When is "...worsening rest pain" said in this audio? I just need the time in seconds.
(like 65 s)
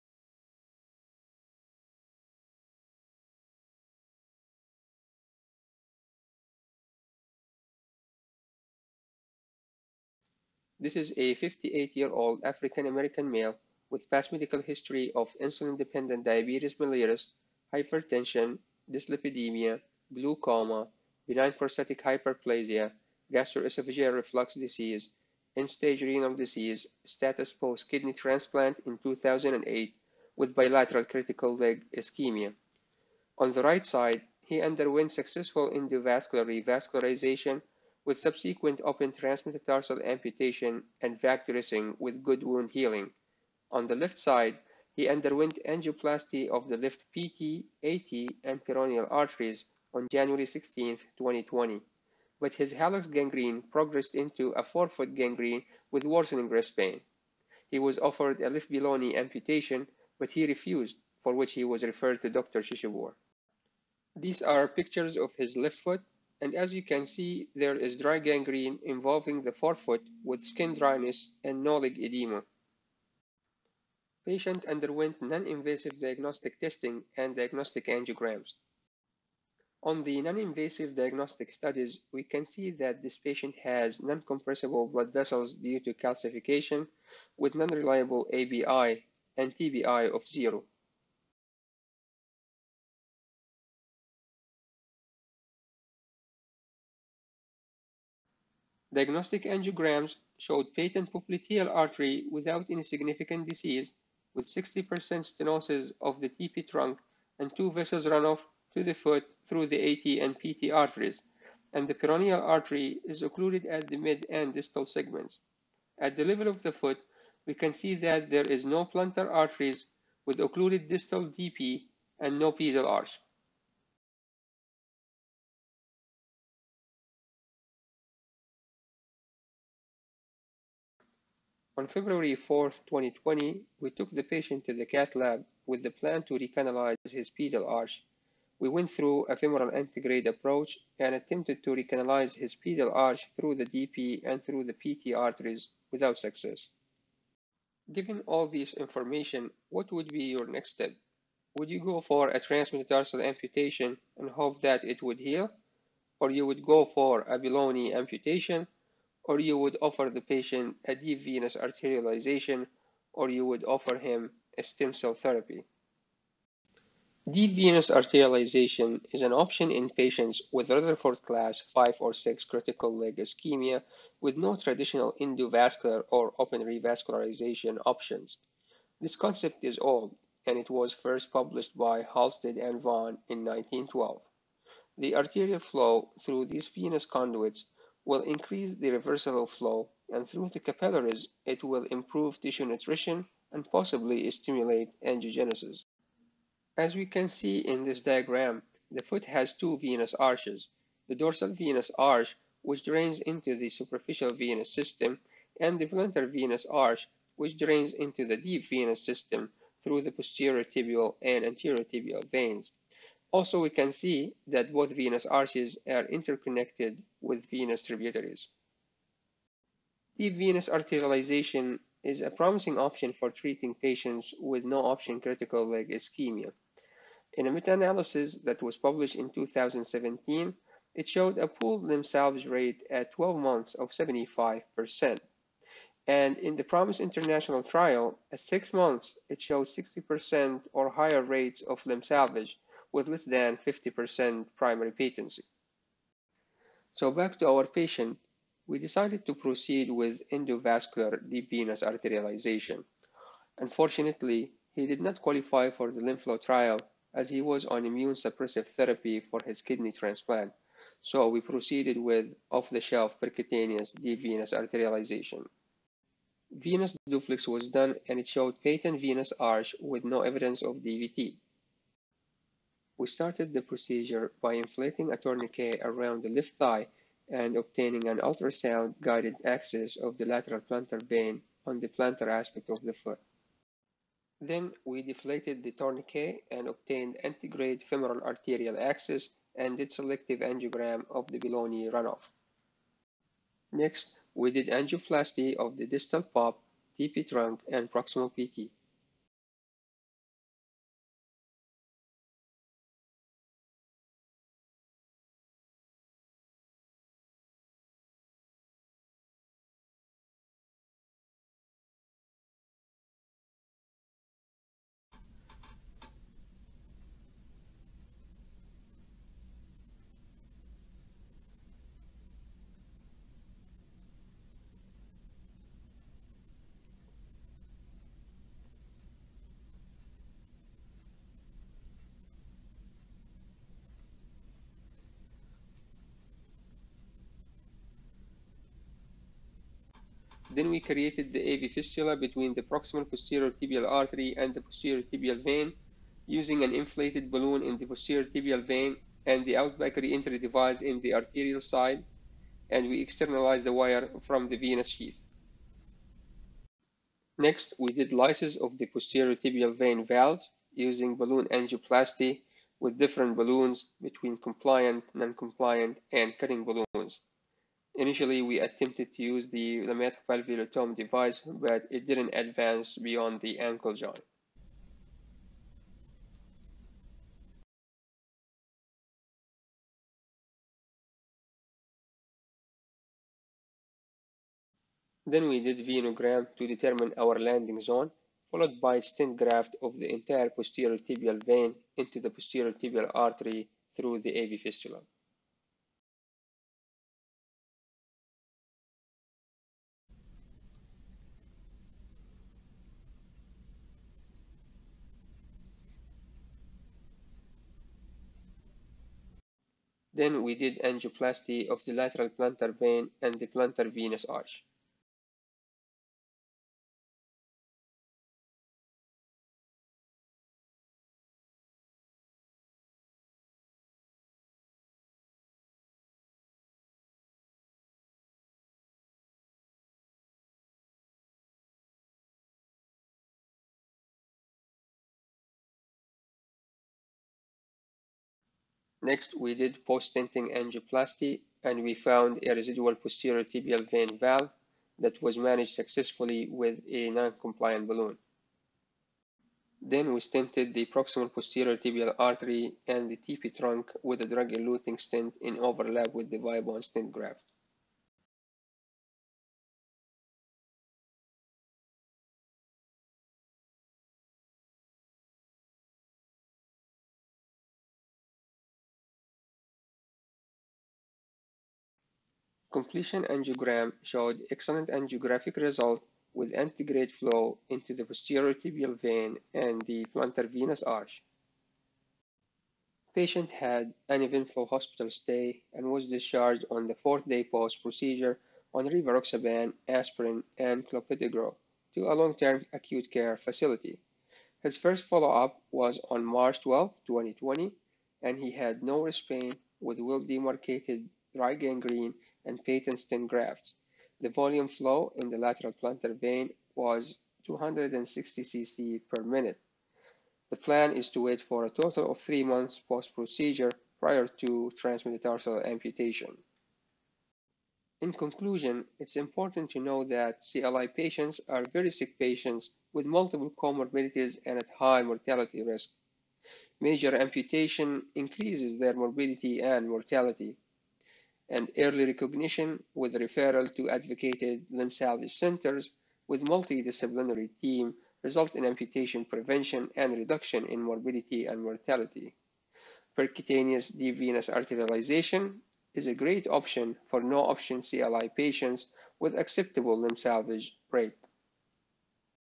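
56 s.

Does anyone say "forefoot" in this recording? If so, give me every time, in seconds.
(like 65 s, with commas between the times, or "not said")
54 s, 69 s.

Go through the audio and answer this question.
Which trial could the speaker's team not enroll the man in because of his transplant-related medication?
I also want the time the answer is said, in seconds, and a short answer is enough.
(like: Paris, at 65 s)
LimFlow, at 256 s.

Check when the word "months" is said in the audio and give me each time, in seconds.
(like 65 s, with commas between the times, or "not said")
233 s, 238 s, 512 s.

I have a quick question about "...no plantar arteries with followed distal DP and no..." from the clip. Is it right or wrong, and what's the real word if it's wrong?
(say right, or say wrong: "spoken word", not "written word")
wrong: "occluded", not "followed".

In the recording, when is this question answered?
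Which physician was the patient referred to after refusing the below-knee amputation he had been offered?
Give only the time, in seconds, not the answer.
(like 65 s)
62 s.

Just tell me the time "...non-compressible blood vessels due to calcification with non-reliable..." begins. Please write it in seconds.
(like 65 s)
84 s.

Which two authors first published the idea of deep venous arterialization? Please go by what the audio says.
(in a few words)
Halsted and Vaughan.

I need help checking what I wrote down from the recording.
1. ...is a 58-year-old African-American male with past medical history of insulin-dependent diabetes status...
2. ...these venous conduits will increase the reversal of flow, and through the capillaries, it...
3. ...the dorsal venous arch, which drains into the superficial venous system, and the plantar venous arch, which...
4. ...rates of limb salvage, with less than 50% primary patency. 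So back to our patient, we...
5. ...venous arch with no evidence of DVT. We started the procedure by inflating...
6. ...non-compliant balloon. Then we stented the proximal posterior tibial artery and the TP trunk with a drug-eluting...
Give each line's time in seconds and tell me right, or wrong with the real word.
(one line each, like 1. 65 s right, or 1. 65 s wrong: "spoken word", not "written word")
1. 10 s wrong: "mellitus", not "status"
2. 186 s right
3. 201 s right
4. 241 s right
5. 269 s right
6. 447 s right.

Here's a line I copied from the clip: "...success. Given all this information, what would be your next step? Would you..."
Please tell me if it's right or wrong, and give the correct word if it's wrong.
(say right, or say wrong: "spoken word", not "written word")
right.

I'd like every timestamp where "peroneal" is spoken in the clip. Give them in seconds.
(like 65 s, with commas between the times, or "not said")
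48 s, 111 s.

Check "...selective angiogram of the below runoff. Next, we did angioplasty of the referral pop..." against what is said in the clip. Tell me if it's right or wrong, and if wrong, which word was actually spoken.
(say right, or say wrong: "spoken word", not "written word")
wrong: "distal", not "referral".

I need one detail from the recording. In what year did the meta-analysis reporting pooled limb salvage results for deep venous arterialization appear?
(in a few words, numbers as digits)
2017.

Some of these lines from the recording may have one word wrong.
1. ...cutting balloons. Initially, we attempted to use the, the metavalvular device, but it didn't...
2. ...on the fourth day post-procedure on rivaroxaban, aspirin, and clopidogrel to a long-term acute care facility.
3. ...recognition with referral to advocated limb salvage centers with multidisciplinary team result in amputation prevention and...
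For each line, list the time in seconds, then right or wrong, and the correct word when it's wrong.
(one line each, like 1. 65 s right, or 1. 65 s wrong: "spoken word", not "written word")
1. 366 s right
2. 486 s right
3. 532 s right.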